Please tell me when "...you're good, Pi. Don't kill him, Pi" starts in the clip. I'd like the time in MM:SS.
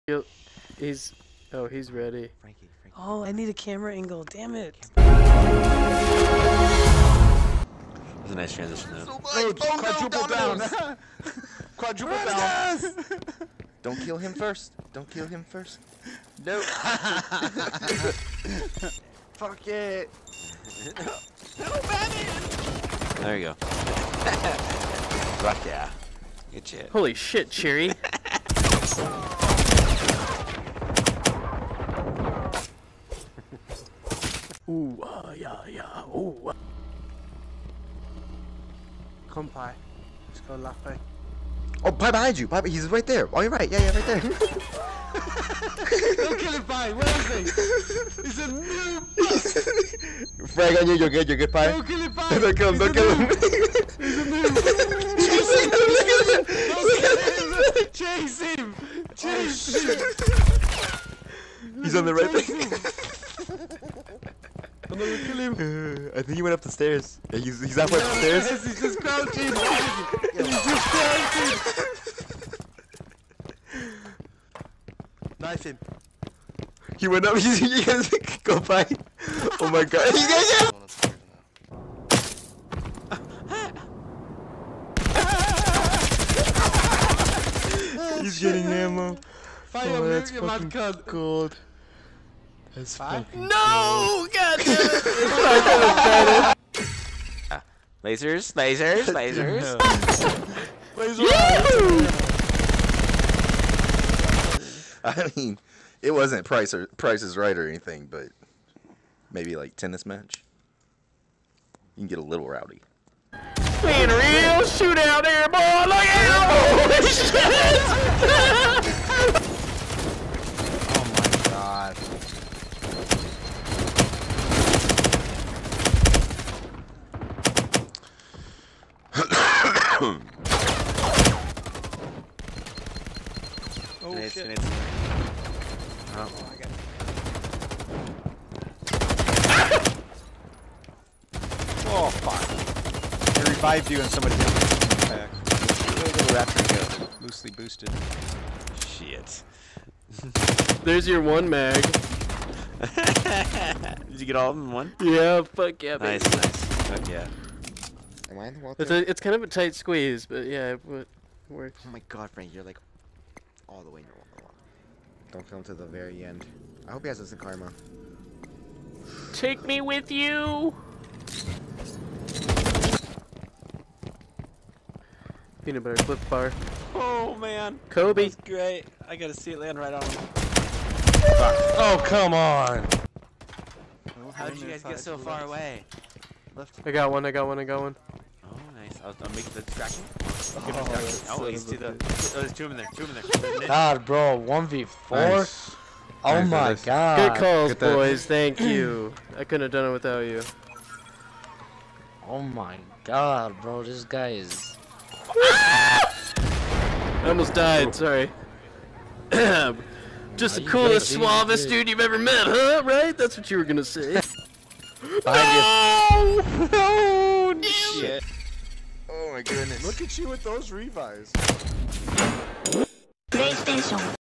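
00:51.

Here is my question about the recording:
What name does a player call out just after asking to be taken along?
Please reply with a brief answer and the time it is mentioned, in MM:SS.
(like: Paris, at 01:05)
Peanut butter flip bar, at 02:55.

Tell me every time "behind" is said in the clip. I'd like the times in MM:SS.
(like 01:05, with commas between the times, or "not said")
00:42, 03:35.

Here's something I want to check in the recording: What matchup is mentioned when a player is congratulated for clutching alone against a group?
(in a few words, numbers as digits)
1v4.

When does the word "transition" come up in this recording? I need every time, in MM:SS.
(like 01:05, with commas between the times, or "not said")
00:08.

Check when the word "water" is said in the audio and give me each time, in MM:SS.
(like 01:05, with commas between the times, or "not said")
02:38, 02:44.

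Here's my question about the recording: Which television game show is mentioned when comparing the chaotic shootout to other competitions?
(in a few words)
Price is Right.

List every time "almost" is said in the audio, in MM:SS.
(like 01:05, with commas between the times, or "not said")
03:27.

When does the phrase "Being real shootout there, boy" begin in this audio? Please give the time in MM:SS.
01:53.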